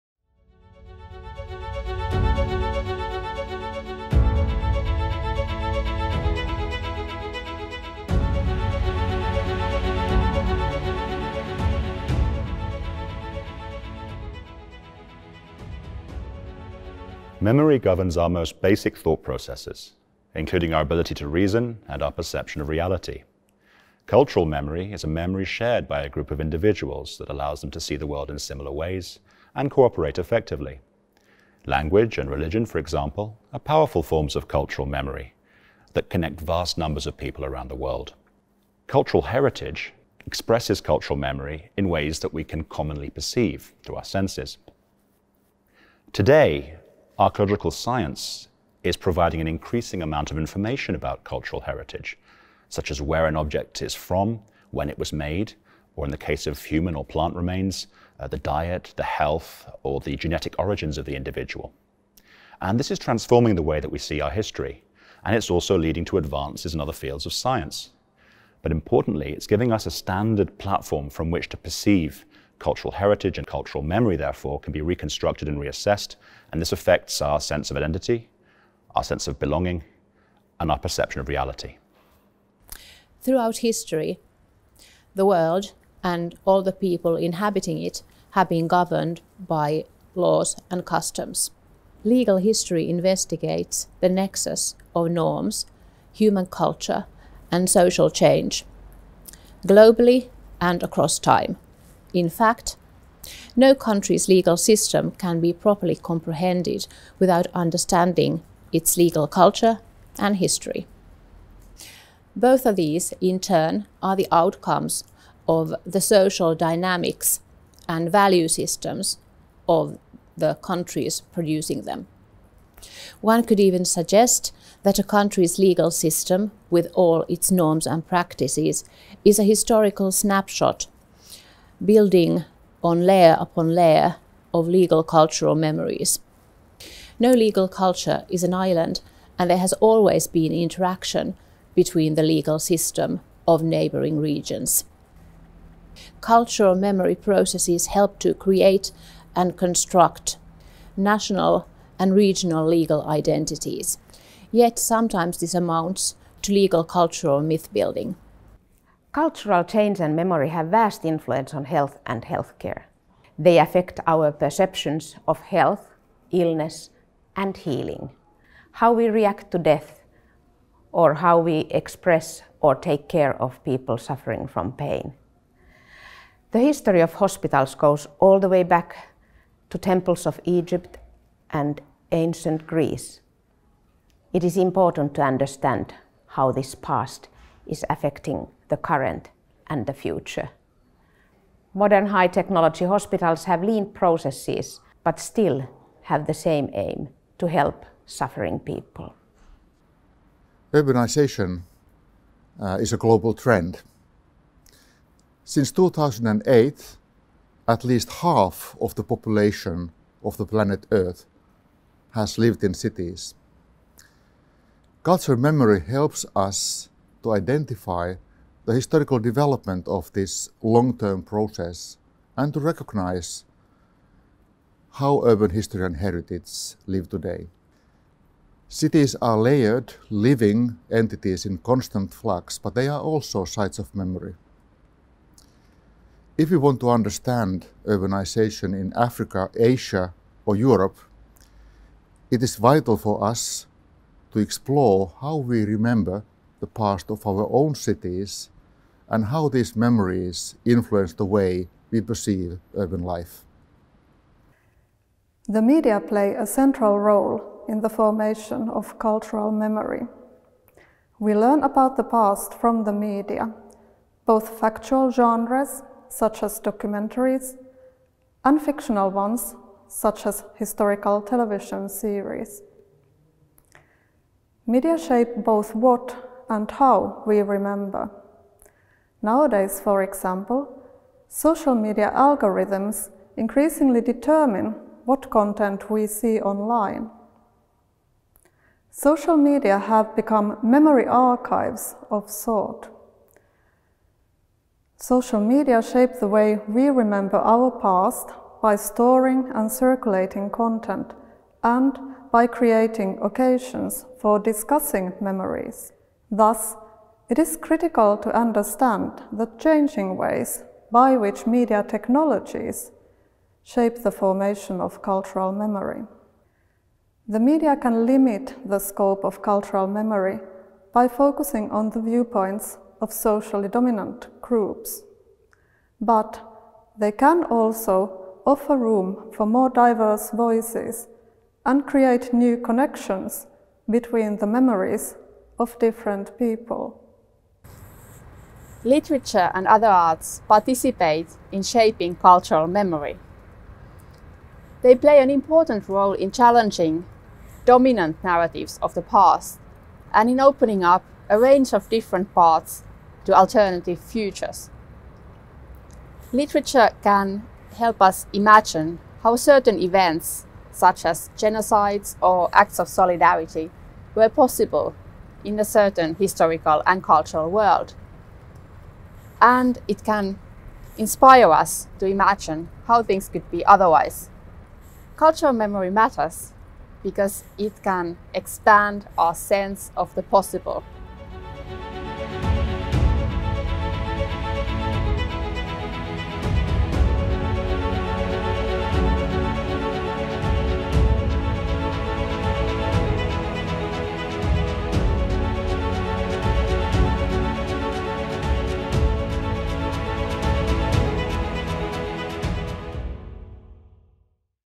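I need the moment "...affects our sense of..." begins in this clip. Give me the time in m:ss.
1:16.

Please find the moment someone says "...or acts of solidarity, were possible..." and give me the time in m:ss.
6:02.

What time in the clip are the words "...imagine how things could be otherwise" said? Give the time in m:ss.
6:12.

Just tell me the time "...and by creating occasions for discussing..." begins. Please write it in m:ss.
5:01.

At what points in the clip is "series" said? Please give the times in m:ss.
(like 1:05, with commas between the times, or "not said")
4:31.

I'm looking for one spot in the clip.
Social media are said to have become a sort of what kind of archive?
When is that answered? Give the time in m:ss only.
4:50.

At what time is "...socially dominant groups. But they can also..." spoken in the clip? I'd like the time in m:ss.
5:23.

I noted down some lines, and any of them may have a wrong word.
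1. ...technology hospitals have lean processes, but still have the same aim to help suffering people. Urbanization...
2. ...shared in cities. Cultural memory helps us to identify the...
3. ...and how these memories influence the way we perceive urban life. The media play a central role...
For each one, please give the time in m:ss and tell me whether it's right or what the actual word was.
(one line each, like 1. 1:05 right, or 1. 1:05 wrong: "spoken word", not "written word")
1. 3:12 right
2. 3:32 wrong: "lived", not "shared"
3. 4:09 right.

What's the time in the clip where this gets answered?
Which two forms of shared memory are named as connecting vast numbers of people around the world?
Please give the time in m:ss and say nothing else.
0:31.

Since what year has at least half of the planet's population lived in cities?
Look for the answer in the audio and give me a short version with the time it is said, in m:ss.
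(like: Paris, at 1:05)
2008, at 3:25.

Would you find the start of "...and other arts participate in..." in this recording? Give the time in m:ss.
5:39.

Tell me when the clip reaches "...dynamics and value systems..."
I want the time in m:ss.
1:56.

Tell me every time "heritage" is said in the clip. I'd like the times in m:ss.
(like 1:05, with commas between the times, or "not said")
0:39, 0:51, 1:12, 3:45.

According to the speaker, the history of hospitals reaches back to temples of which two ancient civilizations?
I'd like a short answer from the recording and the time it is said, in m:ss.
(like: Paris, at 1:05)
Egypt and ancient Greece, at 3:00.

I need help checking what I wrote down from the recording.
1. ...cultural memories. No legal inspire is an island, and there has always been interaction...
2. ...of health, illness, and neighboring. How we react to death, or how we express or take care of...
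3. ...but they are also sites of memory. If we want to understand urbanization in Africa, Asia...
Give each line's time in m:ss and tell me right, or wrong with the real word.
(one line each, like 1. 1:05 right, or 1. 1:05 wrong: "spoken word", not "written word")
1. 2:15 wrong: "culture", not "inspire"
2. 2:45 wrong: "healing", not "neighboring"
3. 3:52 right.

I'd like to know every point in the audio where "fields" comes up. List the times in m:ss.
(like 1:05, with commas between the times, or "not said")
1:07.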